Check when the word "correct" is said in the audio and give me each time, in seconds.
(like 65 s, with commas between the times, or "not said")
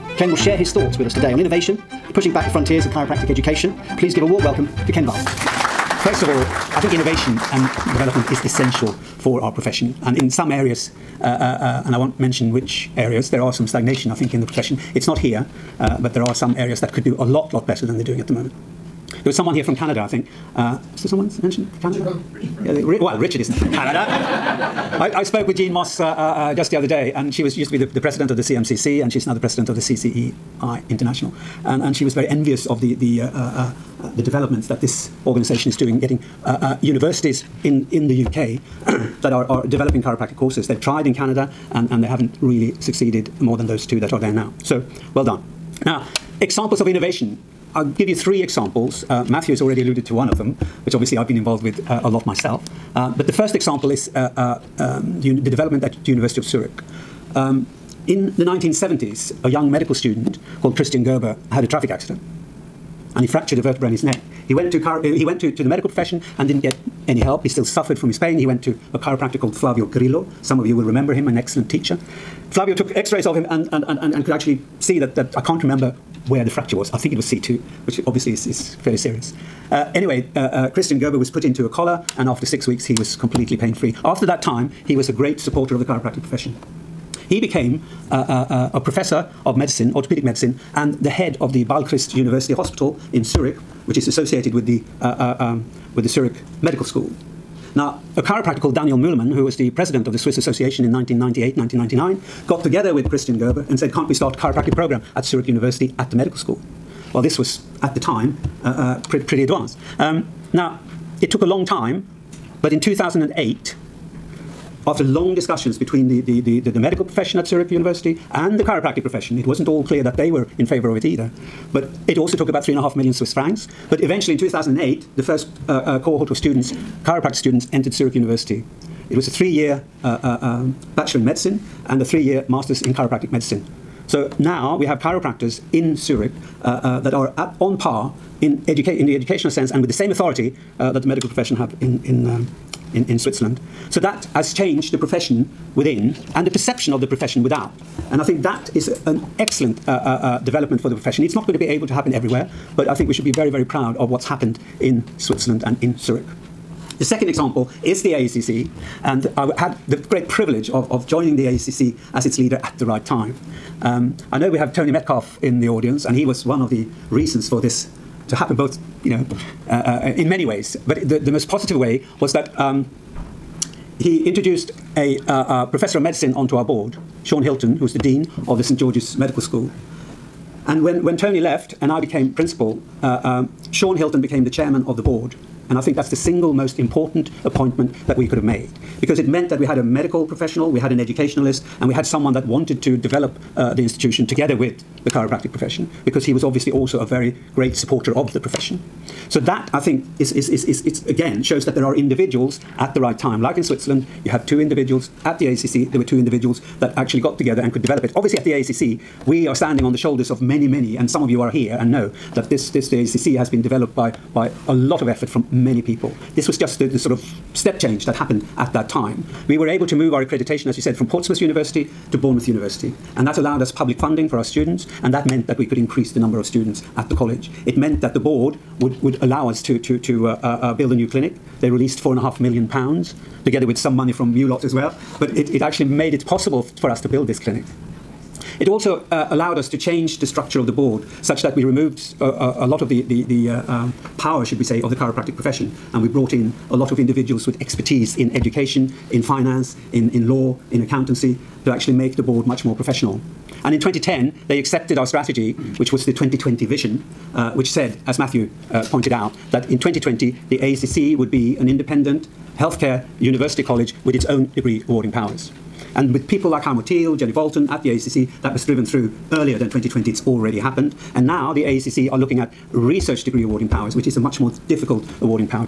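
not said.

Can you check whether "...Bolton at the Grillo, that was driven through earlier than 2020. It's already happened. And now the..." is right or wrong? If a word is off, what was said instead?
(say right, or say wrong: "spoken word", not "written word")
wrong: "ACC", not "Grillo".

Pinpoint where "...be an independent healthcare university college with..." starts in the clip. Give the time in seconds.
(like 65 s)
261 s.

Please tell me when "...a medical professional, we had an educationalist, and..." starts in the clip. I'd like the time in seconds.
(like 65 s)
189 s.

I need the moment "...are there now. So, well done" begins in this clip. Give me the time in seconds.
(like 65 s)
44 s.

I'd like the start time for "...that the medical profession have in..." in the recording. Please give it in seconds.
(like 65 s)
140 s.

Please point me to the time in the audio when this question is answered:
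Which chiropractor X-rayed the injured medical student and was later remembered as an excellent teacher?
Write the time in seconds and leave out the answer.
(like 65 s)
69 s.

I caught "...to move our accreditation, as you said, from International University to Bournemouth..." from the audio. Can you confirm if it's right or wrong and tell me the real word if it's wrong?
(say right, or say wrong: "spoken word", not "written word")
wrong: "Portsmouth", not "International".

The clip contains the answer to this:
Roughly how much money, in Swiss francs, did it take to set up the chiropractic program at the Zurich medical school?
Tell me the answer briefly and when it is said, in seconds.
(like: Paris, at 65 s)
3.5 million Swiss francs, at 122 s.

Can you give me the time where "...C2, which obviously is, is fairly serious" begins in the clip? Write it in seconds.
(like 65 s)
77 s.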